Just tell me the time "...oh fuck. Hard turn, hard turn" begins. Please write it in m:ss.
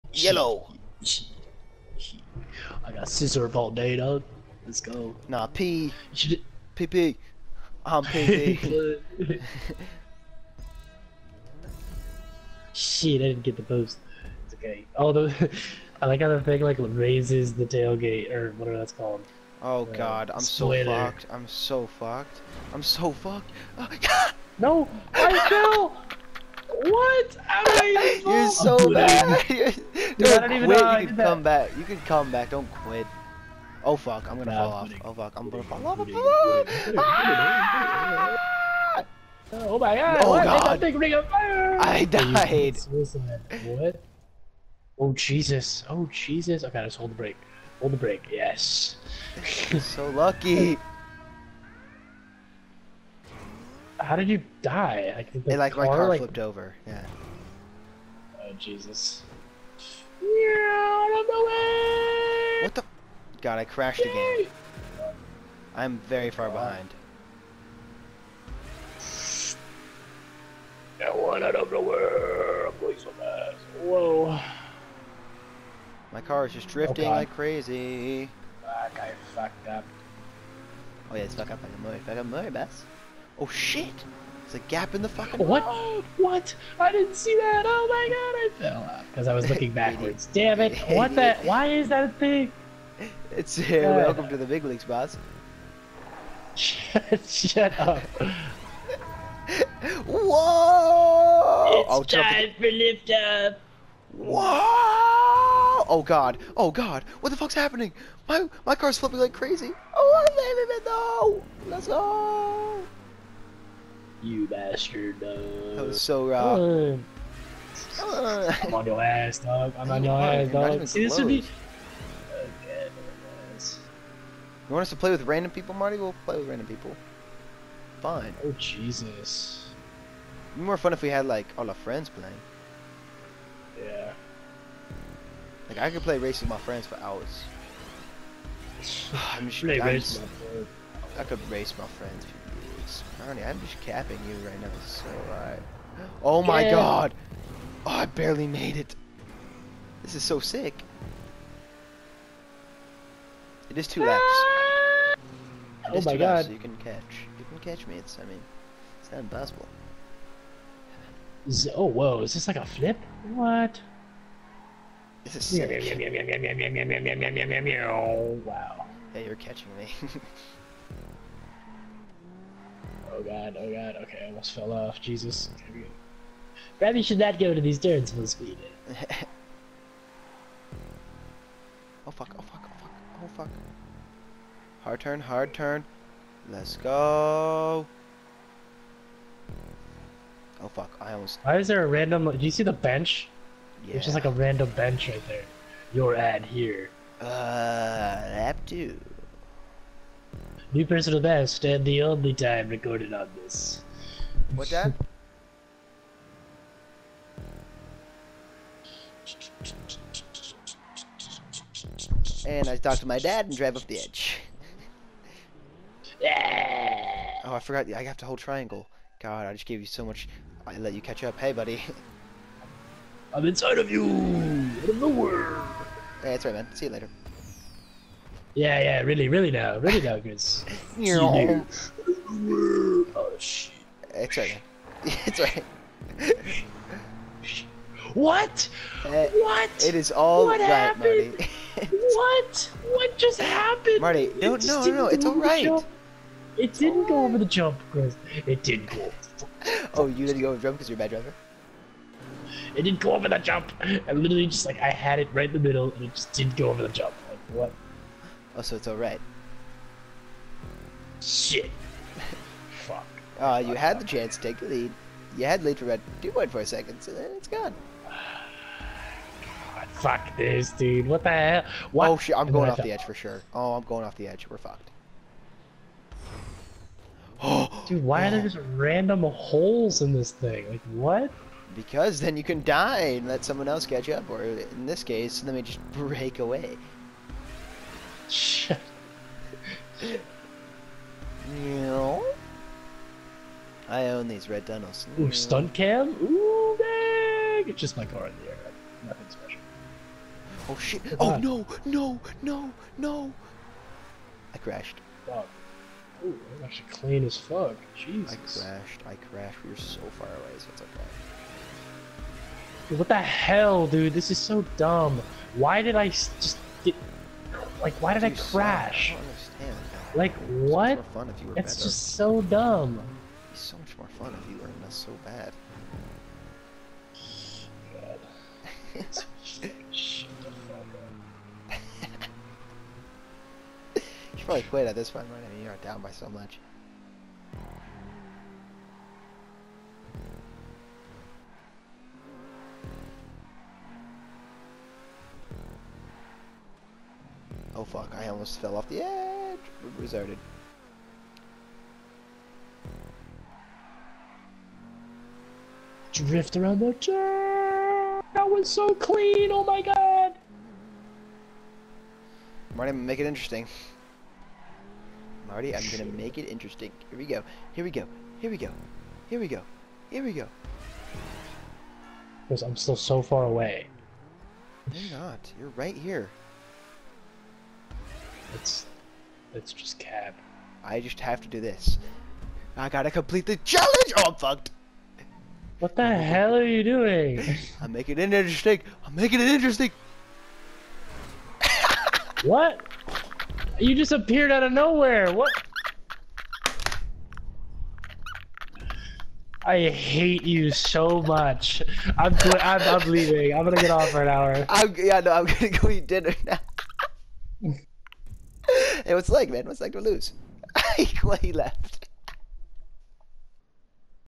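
3:03.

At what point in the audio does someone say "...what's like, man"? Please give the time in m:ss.
6:49.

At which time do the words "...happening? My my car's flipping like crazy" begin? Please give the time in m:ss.
1:47.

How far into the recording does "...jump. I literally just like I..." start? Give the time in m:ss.
4:13.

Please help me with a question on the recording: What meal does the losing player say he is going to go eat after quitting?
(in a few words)
dinner.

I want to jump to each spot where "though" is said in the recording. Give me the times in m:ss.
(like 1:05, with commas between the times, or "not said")
1:51.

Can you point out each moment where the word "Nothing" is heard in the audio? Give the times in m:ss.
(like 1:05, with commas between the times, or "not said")
4:59.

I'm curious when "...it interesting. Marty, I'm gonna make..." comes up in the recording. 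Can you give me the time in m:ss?
6:03.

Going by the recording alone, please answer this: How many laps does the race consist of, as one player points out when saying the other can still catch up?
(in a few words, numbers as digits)
2.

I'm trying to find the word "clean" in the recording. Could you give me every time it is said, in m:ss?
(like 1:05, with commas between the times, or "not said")
5:06, 5:58.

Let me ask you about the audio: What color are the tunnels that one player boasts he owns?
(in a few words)
red.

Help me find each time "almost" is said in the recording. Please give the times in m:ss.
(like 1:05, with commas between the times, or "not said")
2:54, 3:11, 5:48.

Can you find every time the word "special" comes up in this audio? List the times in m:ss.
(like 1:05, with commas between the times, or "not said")
4:59.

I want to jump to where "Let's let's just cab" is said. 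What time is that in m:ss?
6:18.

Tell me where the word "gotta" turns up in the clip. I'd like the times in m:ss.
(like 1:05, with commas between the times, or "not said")
6:22.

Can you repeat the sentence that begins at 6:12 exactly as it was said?
Because I'm still so far away.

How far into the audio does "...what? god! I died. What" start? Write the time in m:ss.
0:40.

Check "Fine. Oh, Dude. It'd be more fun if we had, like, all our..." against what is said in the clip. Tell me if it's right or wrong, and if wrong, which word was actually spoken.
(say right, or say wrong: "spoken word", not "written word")
wrong: "Jesus", not "Dude".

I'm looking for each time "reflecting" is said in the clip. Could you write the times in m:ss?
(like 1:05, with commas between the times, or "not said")
not said.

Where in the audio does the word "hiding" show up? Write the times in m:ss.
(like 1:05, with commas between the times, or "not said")
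not said.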